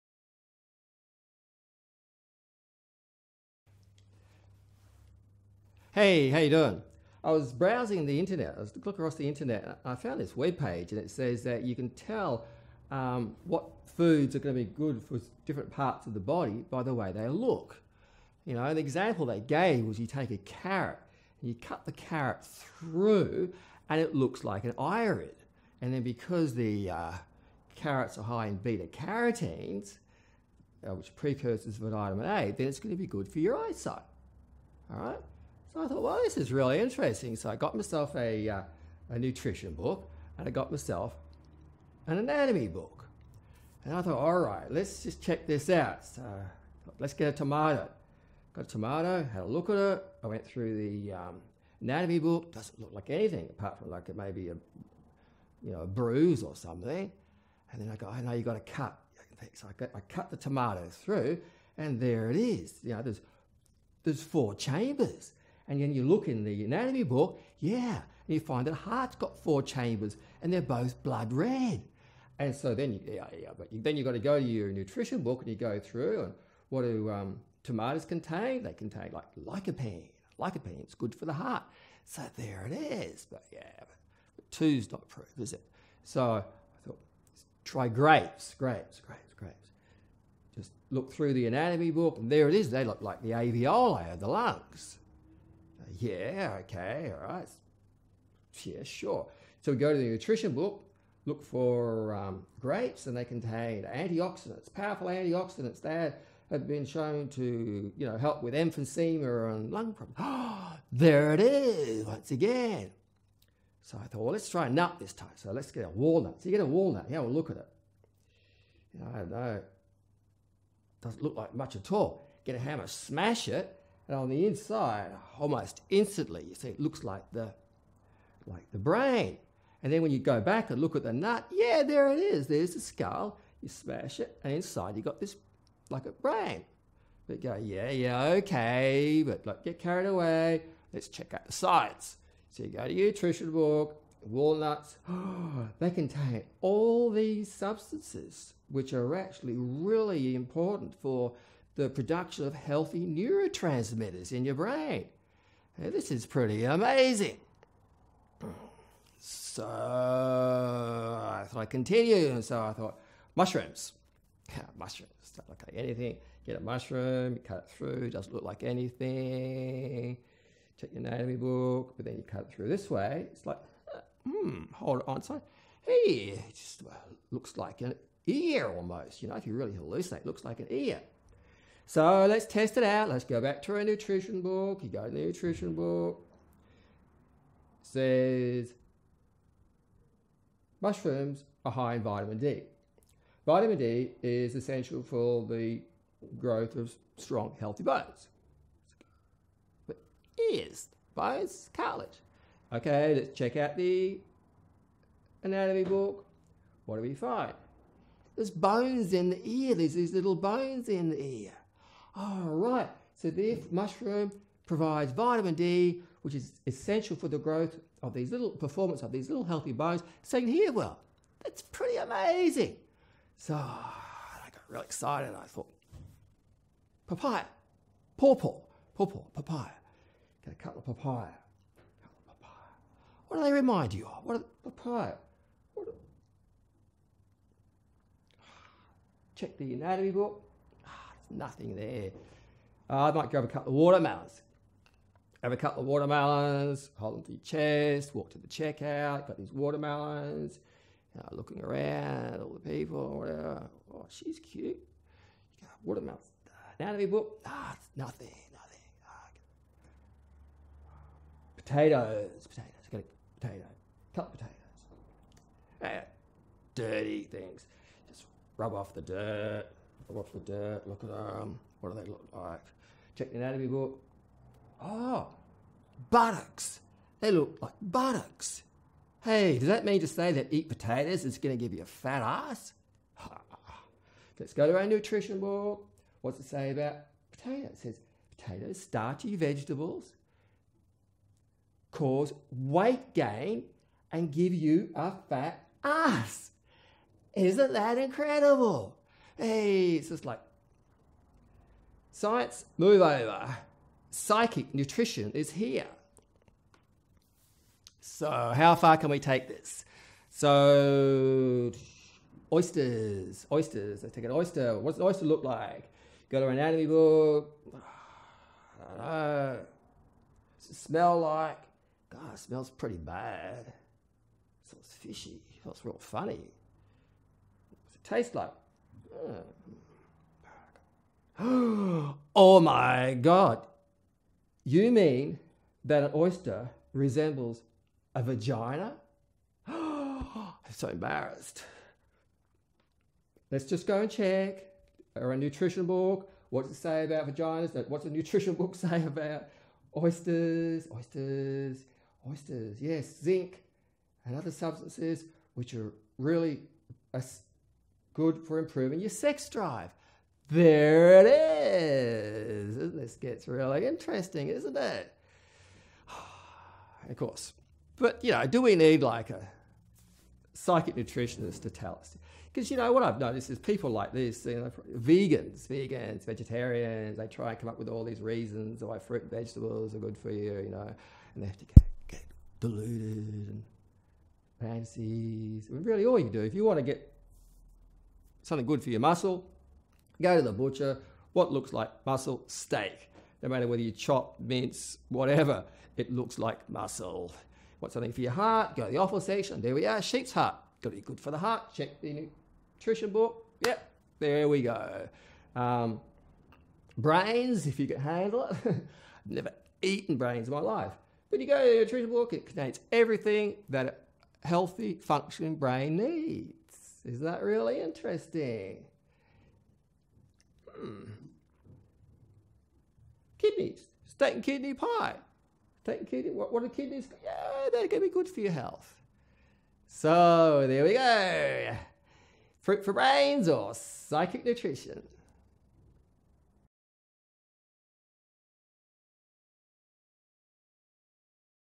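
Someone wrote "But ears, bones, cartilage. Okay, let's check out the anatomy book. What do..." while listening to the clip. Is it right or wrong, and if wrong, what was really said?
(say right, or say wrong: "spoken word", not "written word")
right.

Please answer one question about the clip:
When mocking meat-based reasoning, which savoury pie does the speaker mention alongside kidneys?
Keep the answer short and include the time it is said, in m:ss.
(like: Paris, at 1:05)
steak and kidney pie, at 7:04.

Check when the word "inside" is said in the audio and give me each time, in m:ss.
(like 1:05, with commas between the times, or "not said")
2:04, 2:14.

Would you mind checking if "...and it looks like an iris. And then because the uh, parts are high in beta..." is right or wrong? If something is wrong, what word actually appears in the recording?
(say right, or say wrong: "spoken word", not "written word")
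wrong: "carrots", not "parts".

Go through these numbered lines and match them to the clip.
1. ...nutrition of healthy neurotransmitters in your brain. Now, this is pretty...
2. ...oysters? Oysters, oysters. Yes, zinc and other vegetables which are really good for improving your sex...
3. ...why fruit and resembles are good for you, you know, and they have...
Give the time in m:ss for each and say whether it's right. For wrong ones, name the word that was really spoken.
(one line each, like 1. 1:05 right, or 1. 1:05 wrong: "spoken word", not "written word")
1. 2:31 wrong: "production", not "nutrition"
2. 5:49 wrong: "substances", not "vegetables"
3. 6:18 wrong: "vegetables", not "resembles".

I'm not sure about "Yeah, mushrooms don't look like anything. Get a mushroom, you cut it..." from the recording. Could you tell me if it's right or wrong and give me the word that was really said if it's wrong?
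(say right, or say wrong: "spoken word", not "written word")
right.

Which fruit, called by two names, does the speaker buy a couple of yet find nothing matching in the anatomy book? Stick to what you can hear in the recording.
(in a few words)
papaya, pawpaw.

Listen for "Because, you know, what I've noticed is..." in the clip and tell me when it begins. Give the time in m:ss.
6:12.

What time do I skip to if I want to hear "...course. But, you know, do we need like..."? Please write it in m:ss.
6:07.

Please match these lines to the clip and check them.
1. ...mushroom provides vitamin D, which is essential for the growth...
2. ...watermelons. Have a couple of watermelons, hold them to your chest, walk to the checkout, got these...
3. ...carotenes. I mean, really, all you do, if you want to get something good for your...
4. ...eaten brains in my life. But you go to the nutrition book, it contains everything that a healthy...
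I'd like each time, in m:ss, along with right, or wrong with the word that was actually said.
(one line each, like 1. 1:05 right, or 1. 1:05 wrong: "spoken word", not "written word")
1. 3:33 right
2. 4:03 right
3. 6:24 wrong: "fancies", not "carotenes"
4. 6:49 right.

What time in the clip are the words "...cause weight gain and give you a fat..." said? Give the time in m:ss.
4:51.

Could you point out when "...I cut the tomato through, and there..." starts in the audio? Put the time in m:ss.
0:59.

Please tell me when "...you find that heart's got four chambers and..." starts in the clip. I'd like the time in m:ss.
1:08.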